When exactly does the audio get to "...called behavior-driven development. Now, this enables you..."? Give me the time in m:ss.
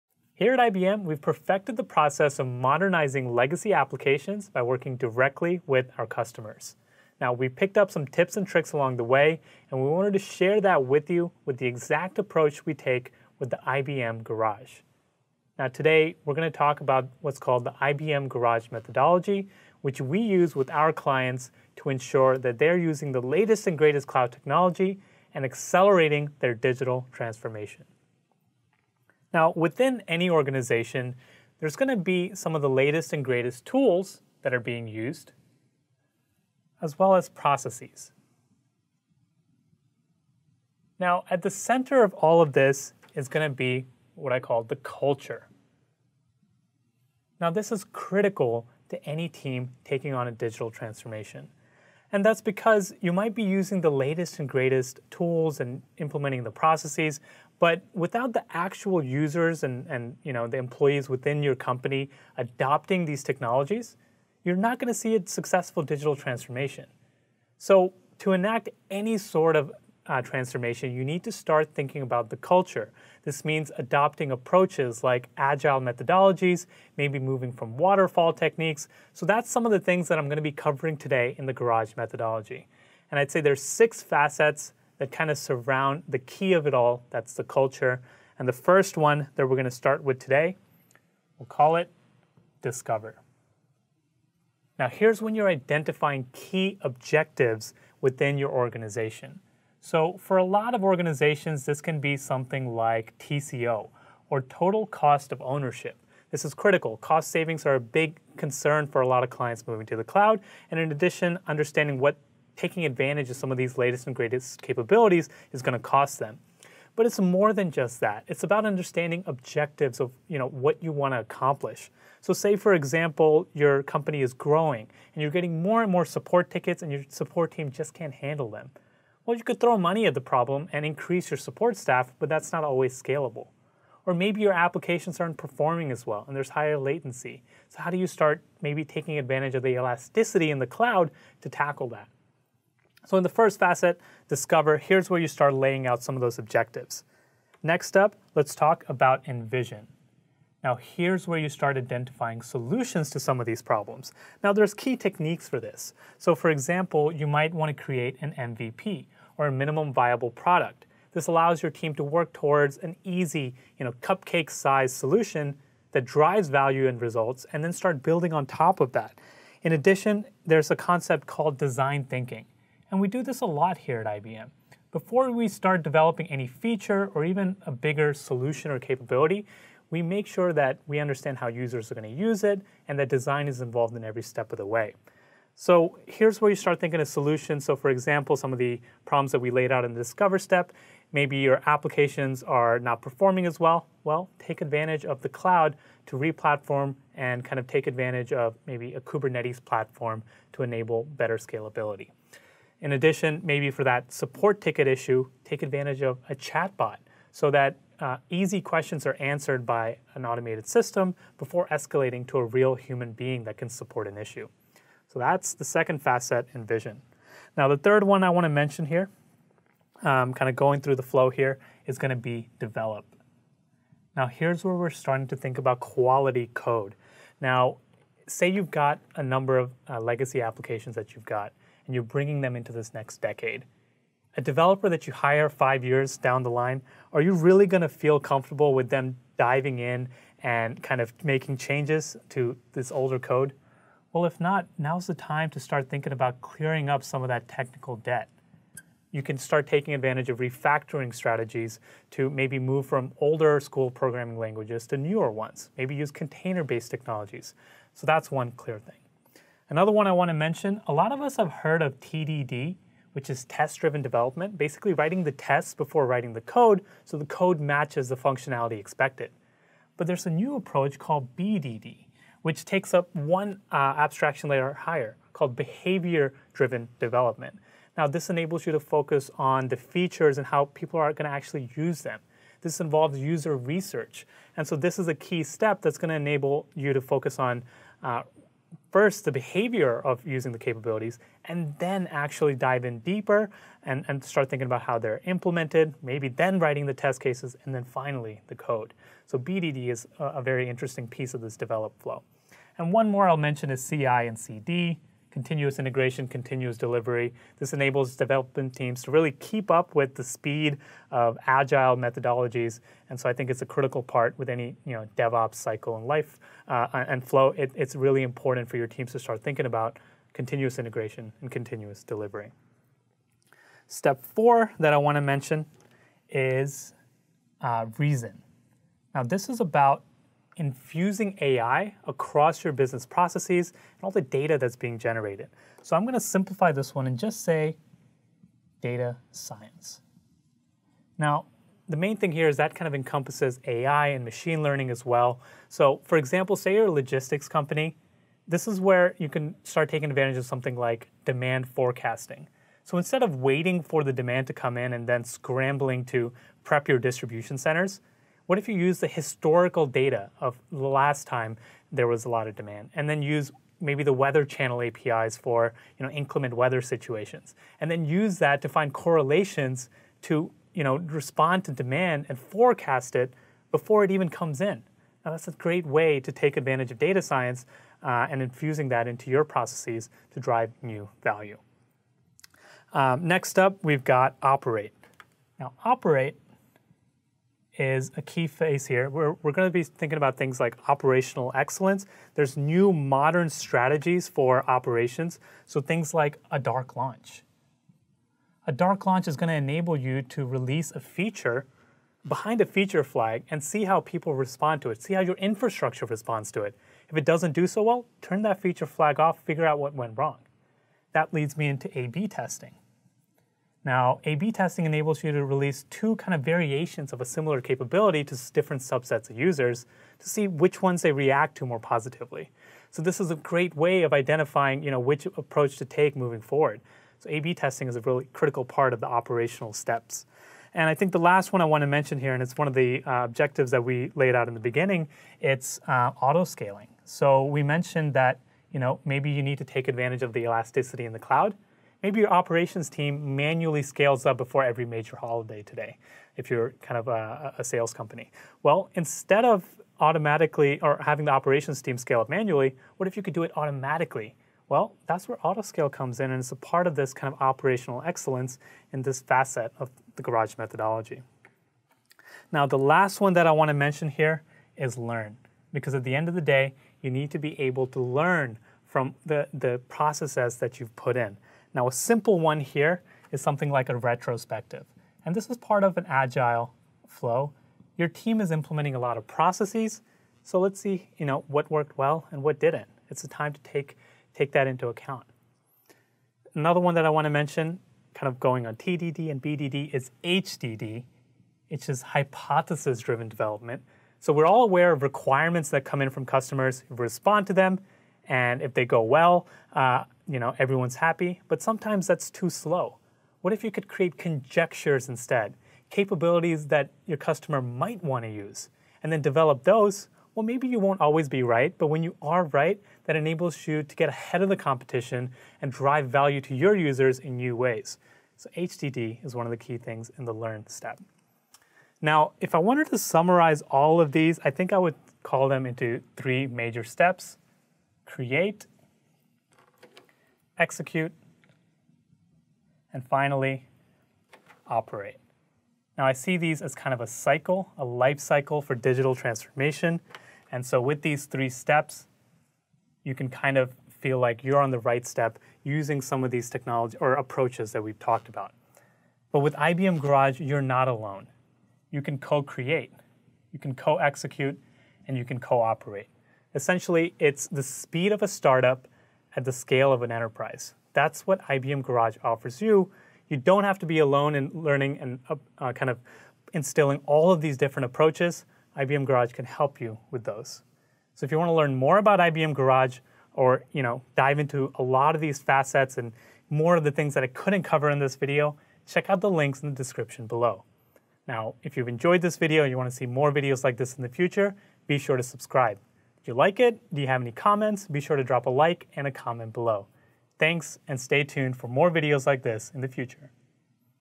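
4:35.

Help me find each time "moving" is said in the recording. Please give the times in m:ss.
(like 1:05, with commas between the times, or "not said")
1:17, 1:49, 7:06.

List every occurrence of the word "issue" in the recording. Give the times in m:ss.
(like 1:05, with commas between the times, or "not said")
3:24, 3:34.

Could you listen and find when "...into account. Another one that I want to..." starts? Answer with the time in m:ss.
8:04.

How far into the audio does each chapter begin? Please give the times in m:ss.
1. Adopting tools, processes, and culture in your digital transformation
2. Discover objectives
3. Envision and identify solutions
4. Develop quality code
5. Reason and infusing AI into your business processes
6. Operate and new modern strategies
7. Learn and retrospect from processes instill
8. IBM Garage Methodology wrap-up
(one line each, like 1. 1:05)
1. 0:28
2. 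1:29
3. 2:27
4. 3:37
5. 5:22
6. 6:22
7. 7:41
8. 8:43.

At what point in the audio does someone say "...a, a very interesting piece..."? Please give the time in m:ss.
5:00.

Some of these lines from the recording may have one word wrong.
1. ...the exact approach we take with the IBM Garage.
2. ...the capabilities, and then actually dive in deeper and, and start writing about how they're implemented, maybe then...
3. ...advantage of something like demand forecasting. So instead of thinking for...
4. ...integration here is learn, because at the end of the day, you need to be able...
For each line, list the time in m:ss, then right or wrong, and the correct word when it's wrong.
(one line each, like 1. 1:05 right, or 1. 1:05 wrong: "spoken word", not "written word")
1. 0:11 right
2. 4:50 wrong: "thinking", not "writing"
3. 5:50 wrong: "waiting", not "thinking"
4. 7:43 wrong: "mention", not "integration".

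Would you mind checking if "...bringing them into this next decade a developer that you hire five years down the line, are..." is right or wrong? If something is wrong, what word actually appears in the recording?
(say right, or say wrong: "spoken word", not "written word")
right.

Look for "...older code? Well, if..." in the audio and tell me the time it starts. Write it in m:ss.
4:02.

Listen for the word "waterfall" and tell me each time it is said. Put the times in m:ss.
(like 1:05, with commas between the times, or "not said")
1:17.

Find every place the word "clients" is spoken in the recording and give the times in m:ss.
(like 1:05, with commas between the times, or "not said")
0:20, 1:49.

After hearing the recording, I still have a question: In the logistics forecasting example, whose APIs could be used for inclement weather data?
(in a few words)
The Weather Channel.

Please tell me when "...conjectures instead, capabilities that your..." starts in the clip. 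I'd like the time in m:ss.
8:24.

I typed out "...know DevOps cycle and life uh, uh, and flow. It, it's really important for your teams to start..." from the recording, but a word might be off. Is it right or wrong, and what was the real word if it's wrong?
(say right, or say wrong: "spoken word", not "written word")
right.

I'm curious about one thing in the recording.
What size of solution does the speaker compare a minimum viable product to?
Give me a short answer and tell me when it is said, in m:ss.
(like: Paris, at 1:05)
Cupcake sized, at 2:44.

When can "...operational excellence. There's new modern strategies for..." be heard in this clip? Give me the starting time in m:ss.
6:30.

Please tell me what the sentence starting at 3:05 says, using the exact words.
So here's where you start thinking of solutions.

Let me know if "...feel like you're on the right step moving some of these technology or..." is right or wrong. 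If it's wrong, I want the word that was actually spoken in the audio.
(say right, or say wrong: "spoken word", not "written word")
wrong: "using", not "moving".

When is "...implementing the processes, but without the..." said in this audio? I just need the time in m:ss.
0:55.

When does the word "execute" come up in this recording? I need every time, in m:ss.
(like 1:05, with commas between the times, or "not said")
8:50, 9:13.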